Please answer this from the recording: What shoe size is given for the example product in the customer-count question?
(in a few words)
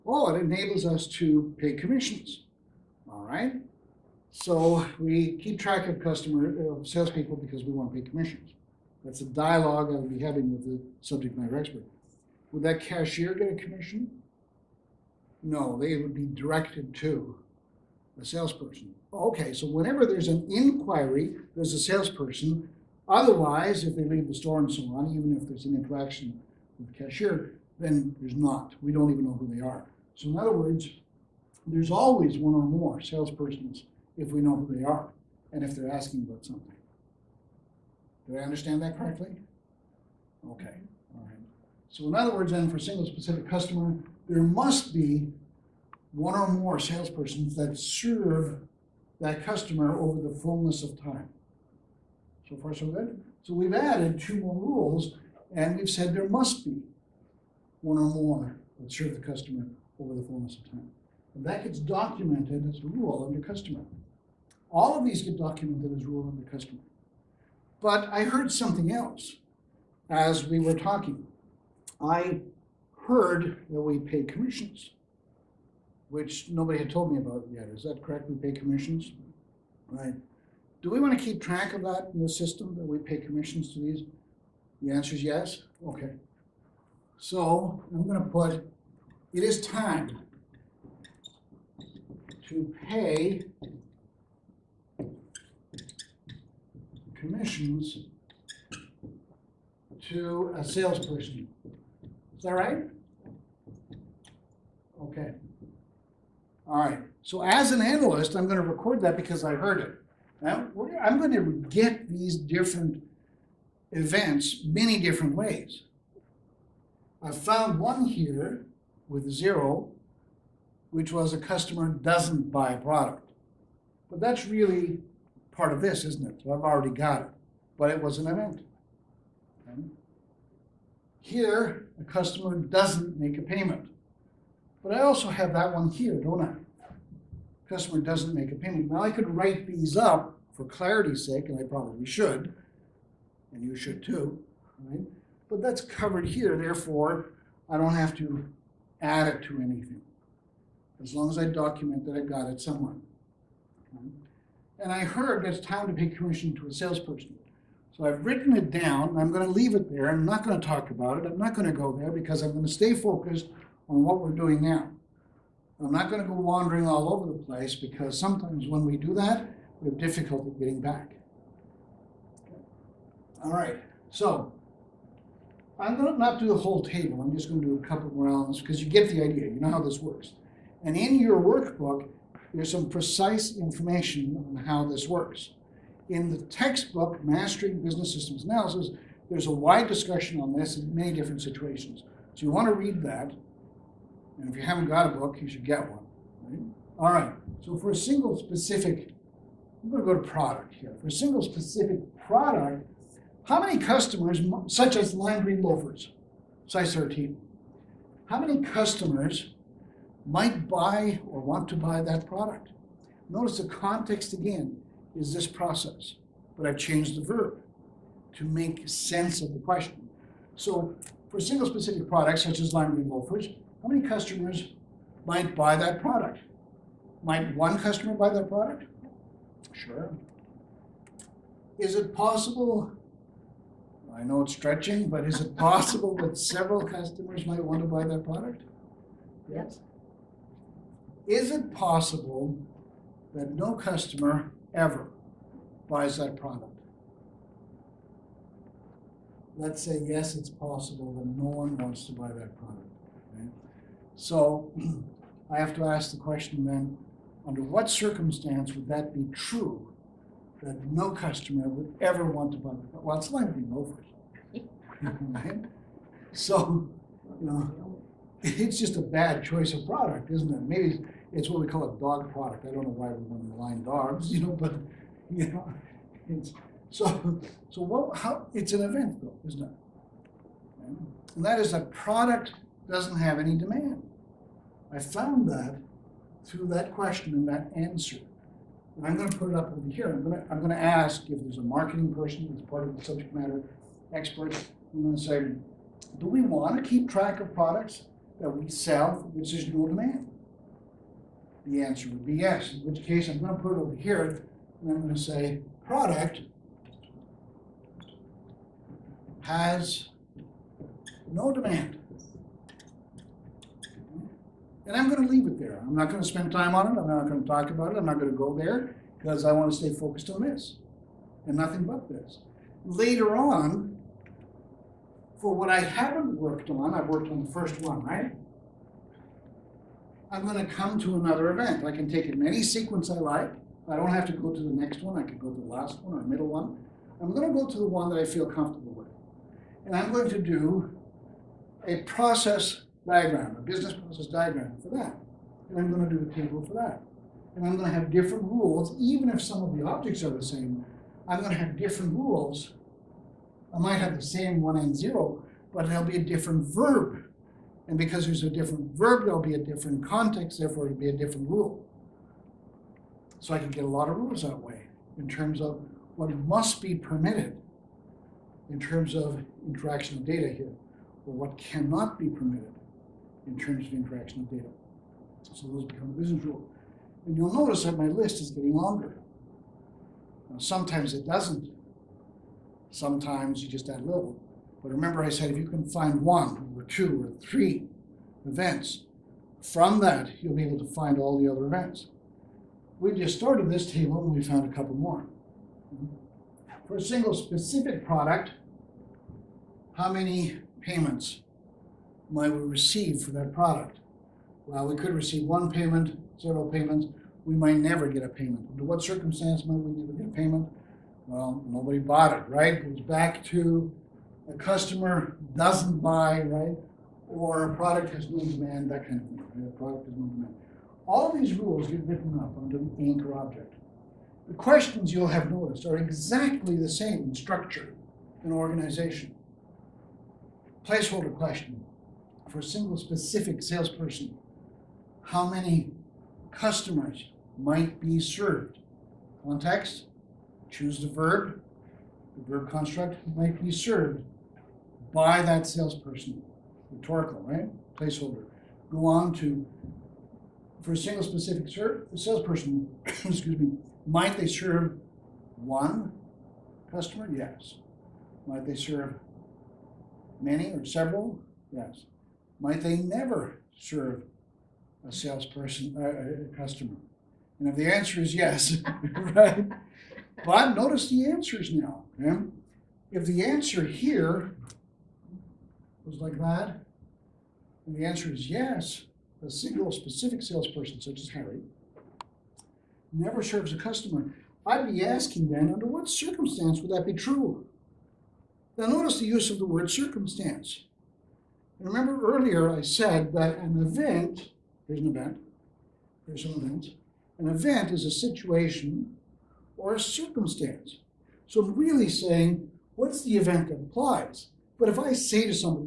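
13.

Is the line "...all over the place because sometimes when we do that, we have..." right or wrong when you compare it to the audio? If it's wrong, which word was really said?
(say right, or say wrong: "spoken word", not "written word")
right.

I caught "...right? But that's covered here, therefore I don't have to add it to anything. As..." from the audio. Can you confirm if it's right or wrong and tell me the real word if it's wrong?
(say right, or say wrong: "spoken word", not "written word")
right.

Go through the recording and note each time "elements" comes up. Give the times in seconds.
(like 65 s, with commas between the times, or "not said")
178 s.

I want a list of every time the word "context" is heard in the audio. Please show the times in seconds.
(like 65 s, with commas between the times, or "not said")
213 s, 360 s, 439 s.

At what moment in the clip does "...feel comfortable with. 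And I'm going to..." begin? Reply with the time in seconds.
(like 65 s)
338 s.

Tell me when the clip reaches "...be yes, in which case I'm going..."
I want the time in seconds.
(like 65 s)
302 s.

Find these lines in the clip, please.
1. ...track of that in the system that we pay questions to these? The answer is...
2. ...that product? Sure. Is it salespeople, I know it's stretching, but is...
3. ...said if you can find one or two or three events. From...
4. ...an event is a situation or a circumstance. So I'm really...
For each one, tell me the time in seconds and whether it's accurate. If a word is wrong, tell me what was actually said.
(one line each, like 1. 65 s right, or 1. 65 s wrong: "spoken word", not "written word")
1. 81 s wrong: "commissions", not "questions"
2. 228 s wrong: "possible", not "salespeople"
3. 385 s right
4. 497 s right.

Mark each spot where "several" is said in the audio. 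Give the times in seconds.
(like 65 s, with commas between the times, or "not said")
236 s, 460 s.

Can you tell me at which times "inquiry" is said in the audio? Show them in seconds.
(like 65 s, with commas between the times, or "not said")
20 s.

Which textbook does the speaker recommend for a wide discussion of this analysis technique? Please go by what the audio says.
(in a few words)
Mastering Business Systems Analysis.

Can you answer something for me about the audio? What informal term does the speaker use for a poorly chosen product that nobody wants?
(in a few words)
Dog product.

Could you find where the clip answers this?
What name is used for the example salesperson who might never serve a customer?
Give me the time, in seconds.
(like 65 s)
481 s.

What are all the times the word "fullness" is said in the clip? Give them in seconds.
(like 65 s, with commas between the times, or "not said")
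50 s, 60 s.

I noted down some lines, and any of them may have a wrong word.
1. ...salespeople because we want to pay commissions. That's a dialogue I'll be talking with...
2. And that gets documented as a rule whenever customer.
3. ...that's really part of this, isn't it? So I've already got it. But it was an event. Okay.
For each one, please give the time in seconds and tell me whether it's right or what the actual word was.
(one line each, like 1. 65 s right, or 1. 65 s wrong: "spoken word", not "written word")
1. 6 s wrong: "having", not "talking"
2. 61 s wrong: "under", not "whenever"
3. 124 s right.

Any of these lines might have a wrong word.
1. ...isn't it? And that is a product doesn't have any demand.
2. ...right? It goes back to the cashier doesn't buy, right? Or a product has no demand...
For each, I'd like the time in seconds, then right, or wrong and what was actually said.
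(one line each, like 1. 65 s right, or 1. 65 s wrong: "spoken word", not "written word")
1. 279 s right
2. 412 s wrong: "customer", not "cashier".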